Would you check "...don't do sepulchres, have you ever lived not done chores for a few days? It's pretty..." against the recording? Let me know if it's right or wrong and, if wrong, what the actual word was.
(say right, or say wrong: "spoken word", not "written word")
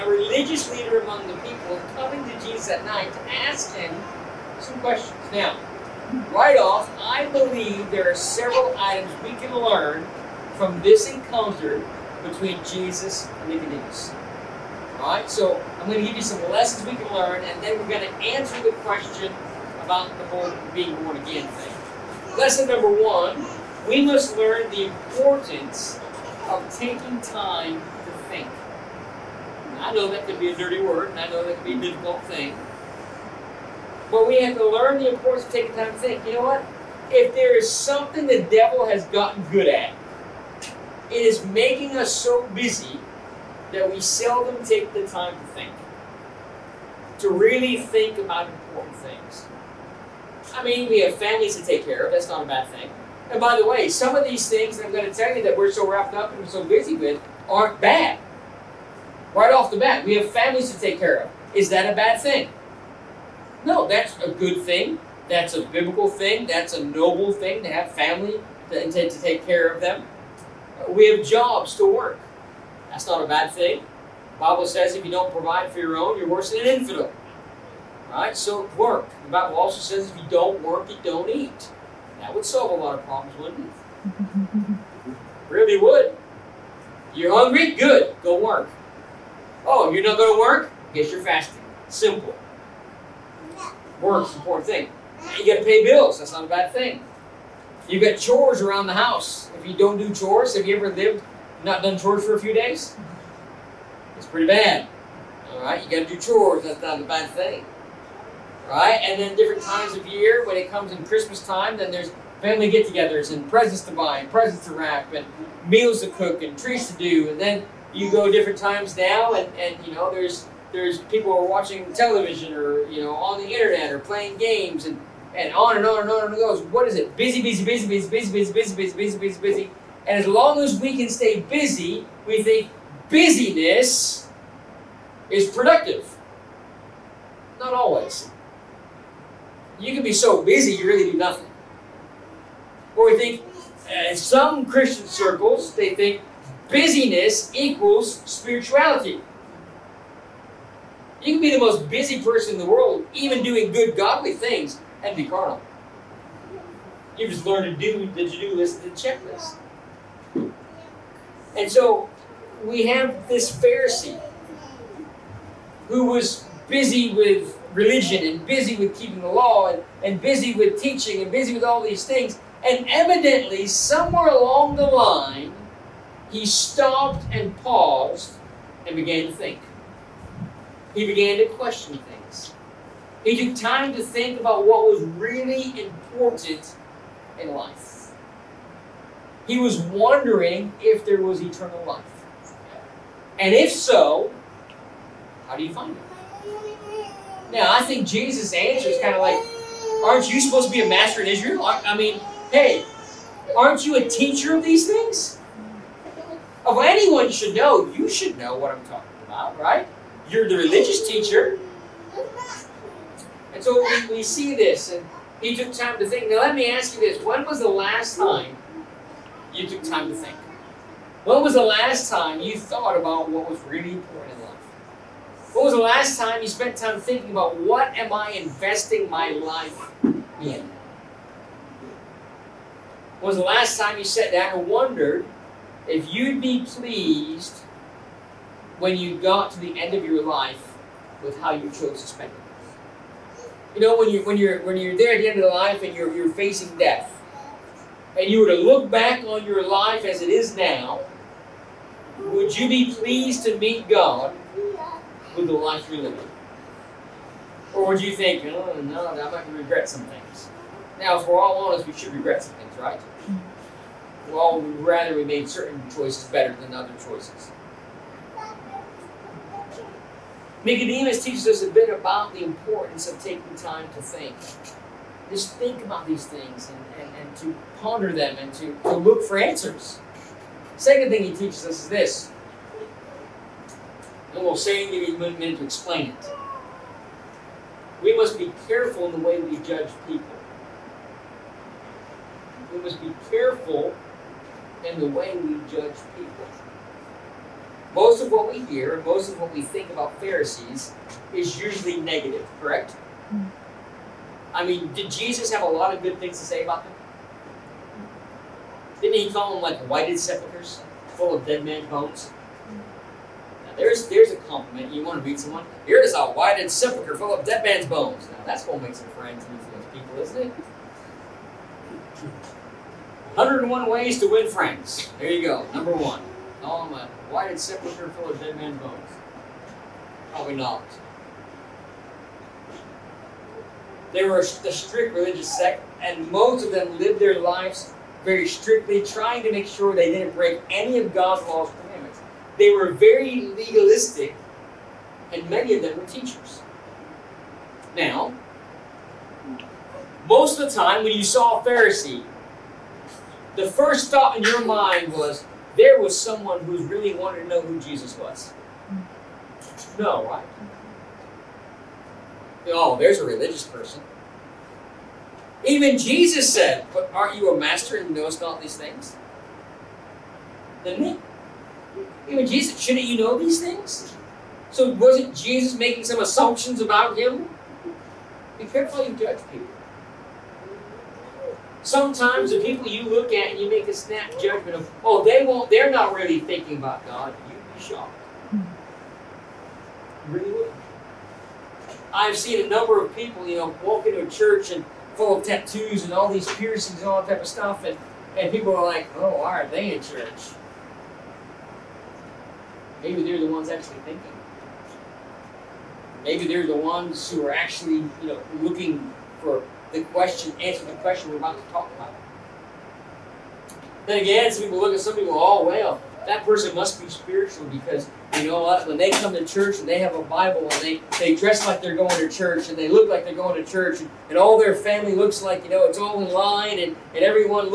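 wrong: "chores", not "sepulchres".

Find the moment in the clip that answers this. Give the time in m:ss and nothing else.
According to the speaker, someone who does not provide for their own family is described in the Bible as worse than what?
1:16.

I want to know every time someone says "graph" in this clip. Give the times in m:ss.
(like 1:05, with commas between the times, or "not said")
not said.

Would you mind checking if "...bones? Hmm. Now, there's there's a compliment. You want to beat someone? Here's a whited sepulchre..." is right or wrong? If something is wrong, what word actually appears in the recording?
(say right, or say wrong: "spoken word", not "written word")
right.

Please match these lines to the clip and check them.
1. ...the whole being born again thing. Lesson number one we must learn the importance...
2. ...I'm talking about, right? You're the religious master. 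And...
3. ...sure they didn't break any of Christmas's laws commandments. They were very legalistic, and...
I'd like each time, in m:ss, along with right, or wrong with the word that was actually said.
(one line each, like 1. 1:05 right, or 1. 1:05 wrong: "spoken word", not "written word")
1. 0:20 right
2. 3:28 wrong: "teacher", not "master"
3. 5:39 wrong: "God", not "Christmas".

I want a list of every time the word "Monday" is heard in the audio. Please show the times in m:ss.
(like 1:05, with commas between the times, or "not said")
not said.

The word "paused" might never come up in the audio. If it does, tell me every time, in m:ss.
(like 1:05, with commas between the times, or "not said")
2:57.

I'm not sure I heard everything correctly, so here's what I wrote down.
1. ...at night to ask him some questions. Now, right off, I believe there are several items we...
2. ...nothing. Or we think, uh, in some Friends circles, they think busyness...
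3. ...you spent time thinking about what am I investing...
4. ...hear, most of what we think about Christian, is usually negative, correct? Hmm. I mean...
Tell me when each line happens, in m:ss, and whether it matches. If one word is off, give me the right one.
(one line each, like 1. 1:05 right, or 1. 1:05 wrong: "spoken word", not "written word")
1. 0:02 right
2. 2:21 wrong: "Christian", not "Friends"
3. 3:46 right
4. 4:58 wrong: "Pharisees", not "Christian".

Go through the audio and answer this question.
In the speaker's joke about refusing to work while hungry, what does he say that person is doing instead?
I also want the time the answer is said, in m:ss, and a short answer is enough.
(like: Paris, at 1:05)
fasting, at 1:31.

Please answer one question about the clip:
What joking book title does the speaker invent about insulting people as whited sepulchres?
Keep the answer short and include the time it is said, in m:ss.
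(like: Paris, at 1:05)
101 Ways to Win Friends, at 5:23.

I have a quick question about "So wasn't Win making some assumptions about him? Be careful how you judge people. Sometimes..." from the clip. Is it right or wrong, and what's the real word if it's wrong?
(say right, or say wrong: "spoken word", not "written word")
wrong: "Jesus", not "Win".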